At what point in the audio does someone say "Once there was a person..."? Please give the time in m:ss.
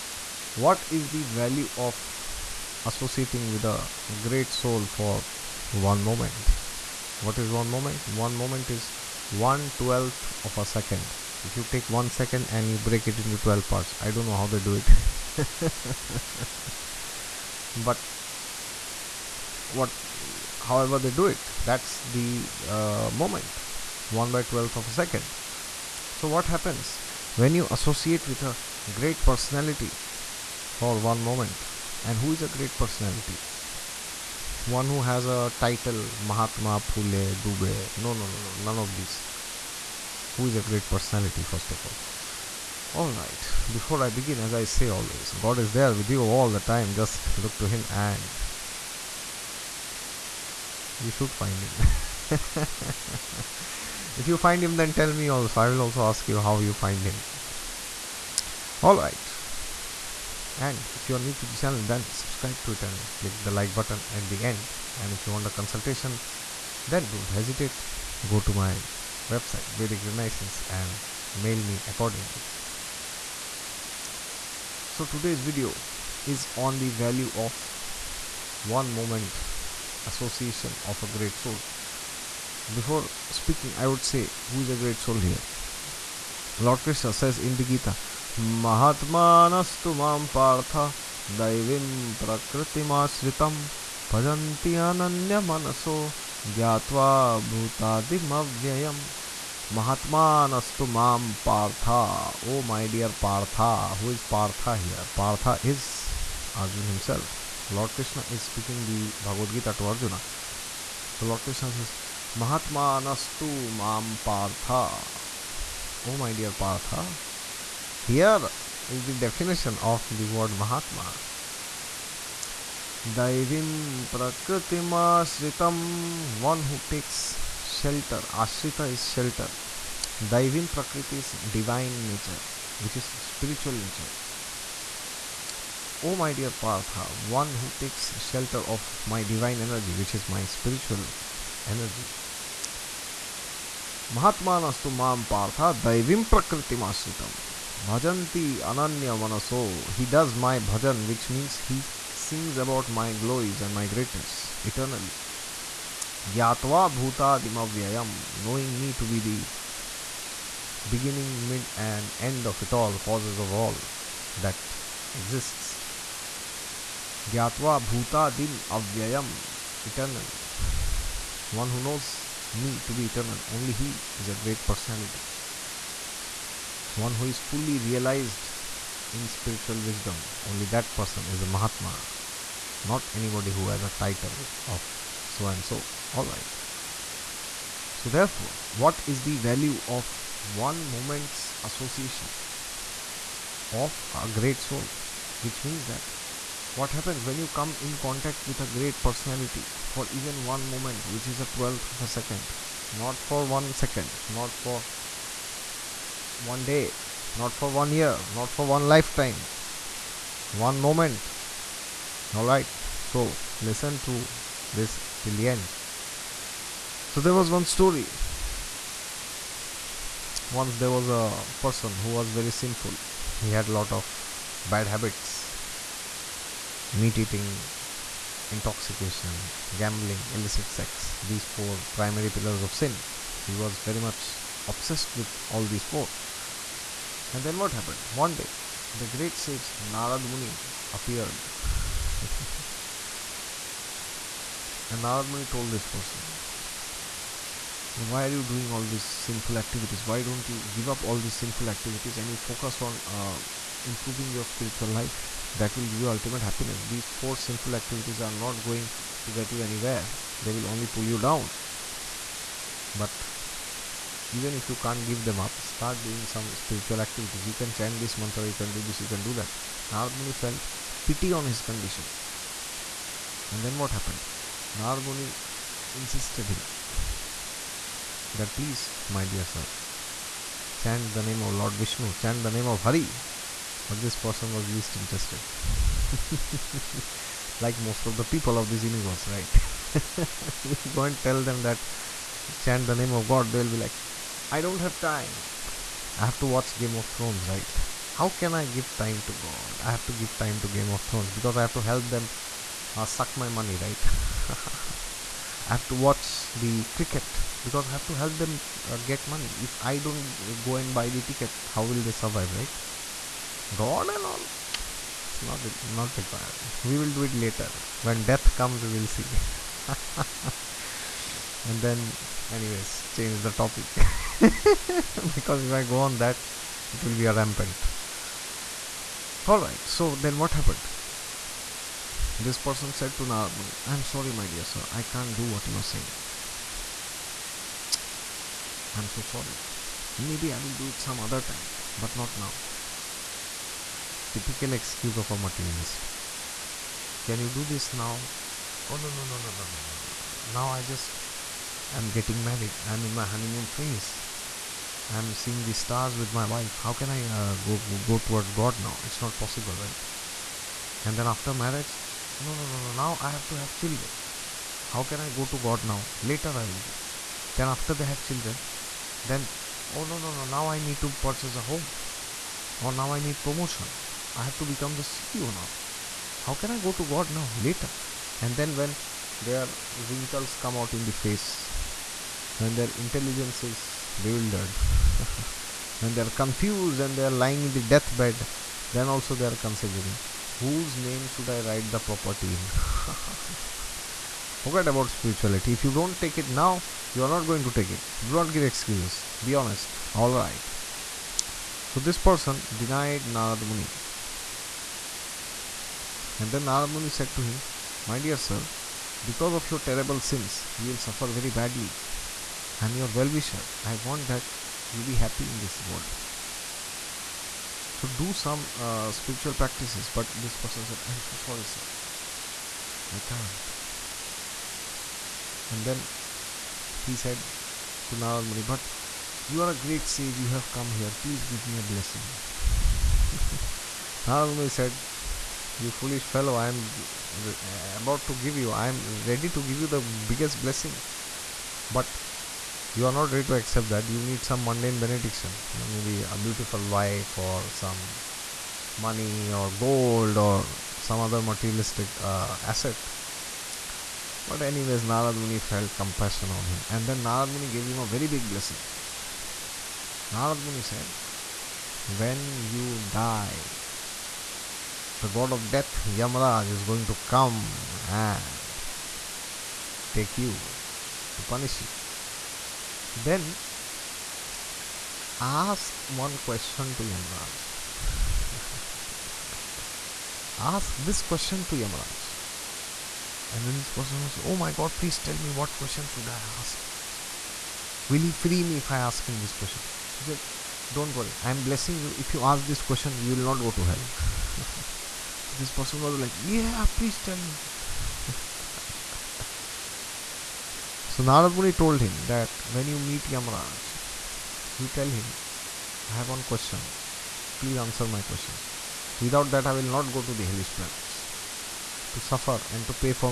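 3:40.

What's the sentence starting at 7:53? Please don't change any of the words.
So then ask one question to Yamaraj.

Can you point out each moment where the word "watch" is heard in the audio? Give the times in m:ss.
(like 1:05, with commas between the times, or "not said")
4:56, 5:05.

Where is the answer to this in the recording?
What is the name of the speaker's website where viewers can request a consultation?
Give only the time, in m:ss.
1:09.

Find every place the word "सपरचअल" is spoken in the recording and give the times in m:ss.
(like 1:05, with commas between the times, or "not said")
2:13, 2:20.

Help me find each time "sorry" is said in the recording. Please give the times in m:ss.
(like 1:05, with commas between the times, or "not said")
5:34, 5:39, 7:01.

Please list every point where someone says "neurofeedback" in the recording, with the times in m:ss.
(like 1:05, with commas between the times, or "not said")
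not said.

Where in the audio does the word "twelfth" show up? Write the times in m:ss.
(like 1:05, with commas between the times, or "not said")
0:09, 3:21.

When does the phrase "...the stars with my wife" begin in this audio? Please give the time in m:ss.
5:55.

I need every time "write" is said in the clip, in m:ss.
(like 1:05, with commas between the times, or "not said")
6:31.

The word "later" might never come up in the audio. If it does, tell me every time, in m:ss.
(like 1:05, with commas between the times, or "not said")
5:17, 6:06, 6:17.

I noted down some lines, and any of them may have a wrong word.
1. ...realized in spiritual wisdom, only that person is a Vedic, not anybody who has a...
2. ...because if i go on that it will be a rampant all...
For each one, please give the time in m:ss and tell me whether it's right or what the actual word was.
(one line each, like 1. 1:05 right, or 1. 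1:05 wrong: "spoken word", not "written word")
1. 2:57 wrong: "Mahatma", not "Vedic"
2. 5:25 right.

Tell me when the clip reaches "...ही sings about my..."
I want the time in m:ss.
2:31.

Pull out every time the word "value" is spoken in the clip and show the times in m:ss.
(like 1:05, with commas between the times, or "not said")
0:01, 1:16, 3:09.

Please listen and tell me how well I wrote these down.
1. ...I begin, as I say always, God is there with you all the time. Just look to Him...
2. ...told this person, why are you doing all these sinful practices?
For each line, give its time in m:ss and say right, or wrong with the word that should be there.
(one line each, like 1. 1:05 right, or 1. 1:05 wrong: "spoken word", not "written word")
1. 0:44 right
2. 4:05 wrong: "activities", not "practices".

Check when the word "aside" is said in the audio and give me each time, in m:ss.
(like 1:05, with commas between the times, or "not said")
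not said.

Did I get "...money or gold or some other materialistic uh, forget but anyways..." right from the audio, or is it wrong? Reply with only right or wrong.
wrong.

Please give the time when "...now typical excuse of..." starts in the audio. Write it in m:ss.
5:42.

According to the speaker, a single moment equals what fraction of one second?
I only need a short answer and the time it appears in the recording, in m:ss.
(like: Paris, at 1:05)
1/12, at 0:09.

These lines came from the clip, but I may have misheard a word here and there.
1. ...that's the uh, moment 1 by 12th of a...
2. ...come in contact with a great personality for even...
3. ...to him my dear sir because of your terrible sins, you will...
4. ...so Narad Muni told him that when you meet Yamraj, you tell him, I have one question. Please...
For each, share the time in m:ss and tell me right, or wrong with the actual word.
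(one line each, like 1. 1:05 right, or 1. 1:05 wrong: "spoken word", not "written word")
1. 0:21 right
2. 3:17 right
3. 6:47 right
4. 8:21 right.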